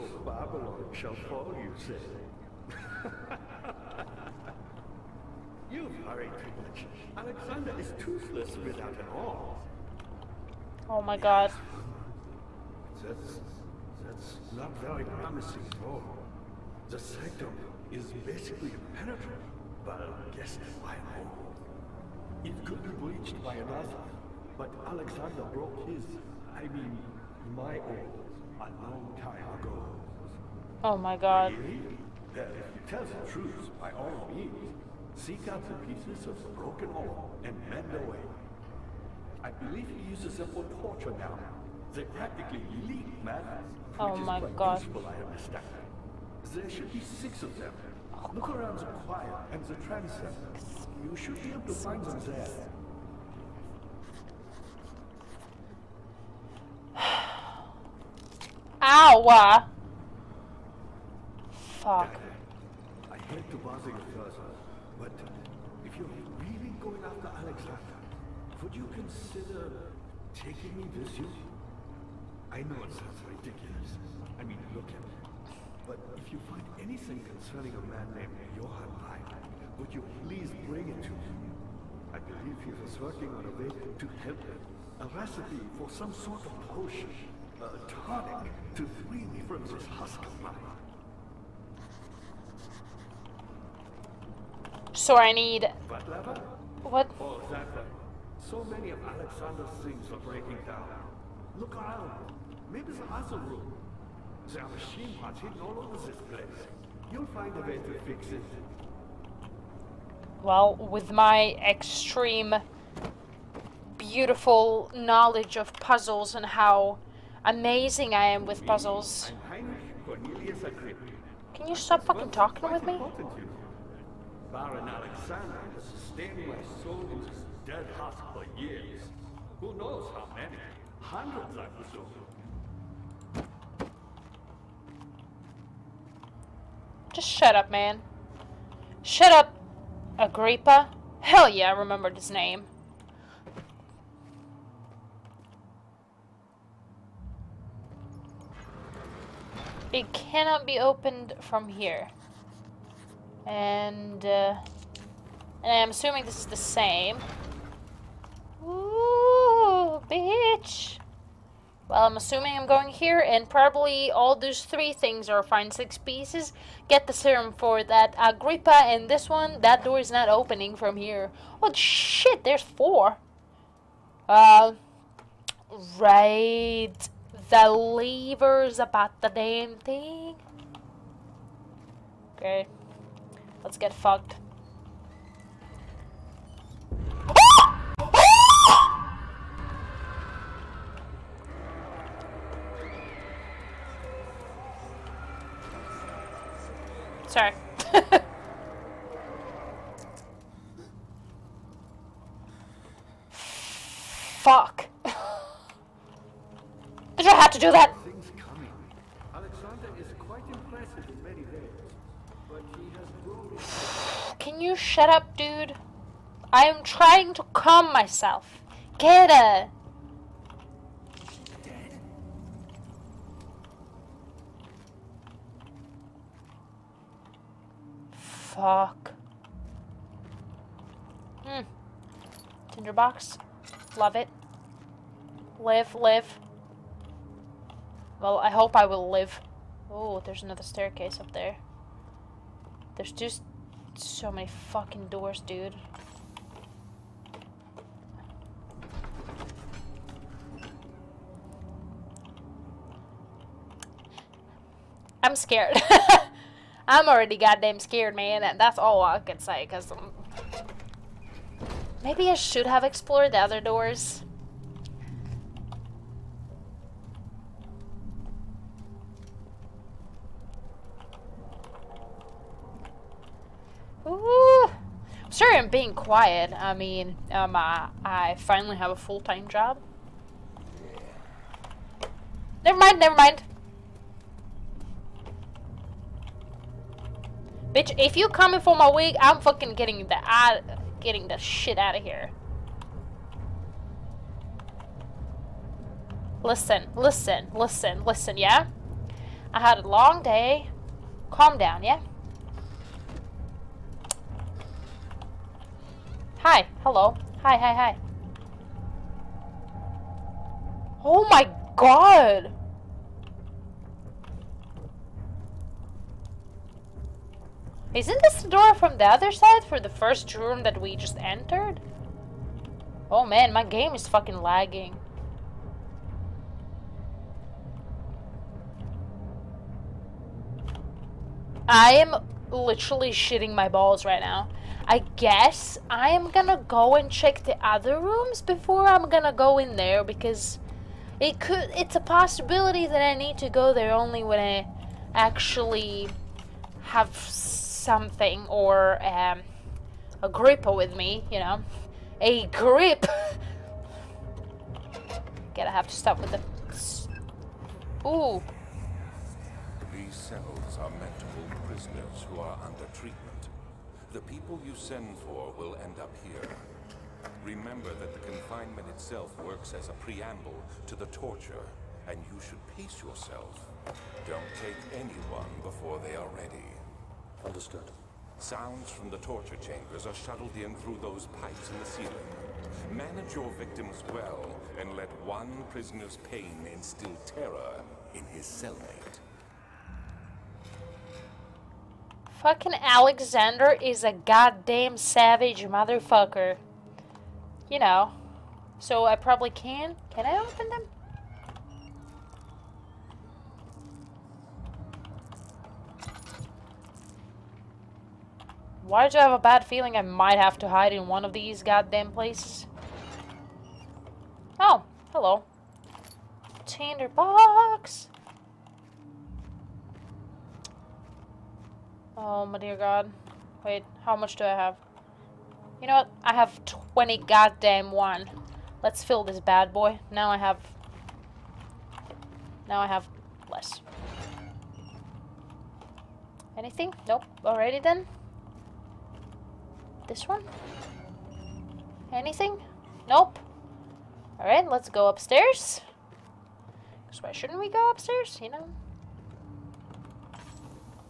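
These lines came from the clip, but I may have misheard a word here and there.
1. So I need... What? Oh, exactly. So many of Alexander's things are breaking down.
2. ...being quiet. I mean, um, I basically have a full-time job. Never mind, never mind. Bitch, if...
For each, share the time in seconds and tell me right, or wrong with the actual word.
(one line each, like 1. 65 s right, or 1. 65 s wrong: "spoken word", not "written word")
1. 94 s right
2. 275 s wrong: "finally", not "basically".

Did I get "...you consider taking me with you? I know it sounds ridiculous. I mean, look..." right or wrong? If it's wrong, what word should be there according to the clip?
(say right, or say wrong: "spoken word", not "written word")
right.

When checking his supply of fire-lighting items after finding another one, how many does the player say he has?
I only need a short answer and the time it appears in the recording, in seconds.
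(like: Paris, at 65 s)
21, at 426 s.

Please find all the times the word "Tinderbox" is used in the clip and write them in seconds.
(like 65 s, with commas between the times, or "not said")
232 s, 416 s.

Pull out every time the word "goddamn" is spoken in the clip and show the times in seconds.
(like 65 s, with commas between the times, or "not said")
257 s, 394 s, 411 s, 427 s.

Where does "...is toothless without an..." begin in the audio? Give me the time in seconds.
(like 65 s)
7 s.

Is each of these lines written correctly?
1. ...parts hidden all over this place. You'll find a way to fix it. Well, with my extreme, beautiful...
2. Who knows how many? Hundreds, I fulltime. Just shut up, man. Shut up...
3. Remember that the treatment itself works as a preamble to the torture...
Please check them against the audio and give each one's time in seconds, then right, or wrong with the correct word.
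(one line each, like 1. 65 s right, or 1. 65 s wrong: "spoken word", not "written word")
1. 105 s right
2. 129 s wrong: "presume", not "fulltime"
3. 367 s wrong: "confinement", not "treatment".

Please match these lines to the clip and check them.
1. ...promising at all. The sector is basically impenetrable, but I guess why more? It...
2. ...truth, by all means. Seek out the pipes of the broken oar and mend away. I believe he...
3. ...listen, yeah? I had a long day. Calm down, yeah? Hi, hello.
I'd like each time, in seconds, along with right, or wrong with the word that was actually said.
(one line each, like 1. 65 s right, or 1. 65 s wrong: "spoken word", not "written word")
1. 15 s right
2. 33 s wrong: "pieces", not "pipes"
3. 298 s right.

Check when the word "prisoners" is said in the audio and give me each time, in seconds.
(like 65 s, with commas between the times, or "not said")
361 s, 385 s.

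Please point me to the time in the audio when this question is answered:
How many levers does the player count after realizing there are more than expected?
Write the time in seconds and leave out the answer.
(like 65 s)
172 s.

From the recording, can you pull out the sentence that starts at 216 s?
I am trying to calm myself.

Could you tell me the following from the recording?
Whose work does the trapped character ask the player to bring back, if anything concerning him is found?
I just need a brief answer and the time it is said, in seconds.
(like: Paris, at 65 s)
Johann Reich, at 78 s.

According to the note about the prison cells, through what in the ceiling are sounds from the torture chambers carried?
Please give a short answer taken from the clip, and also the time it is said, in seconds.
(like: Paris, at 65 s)
Pipes, at 381 s.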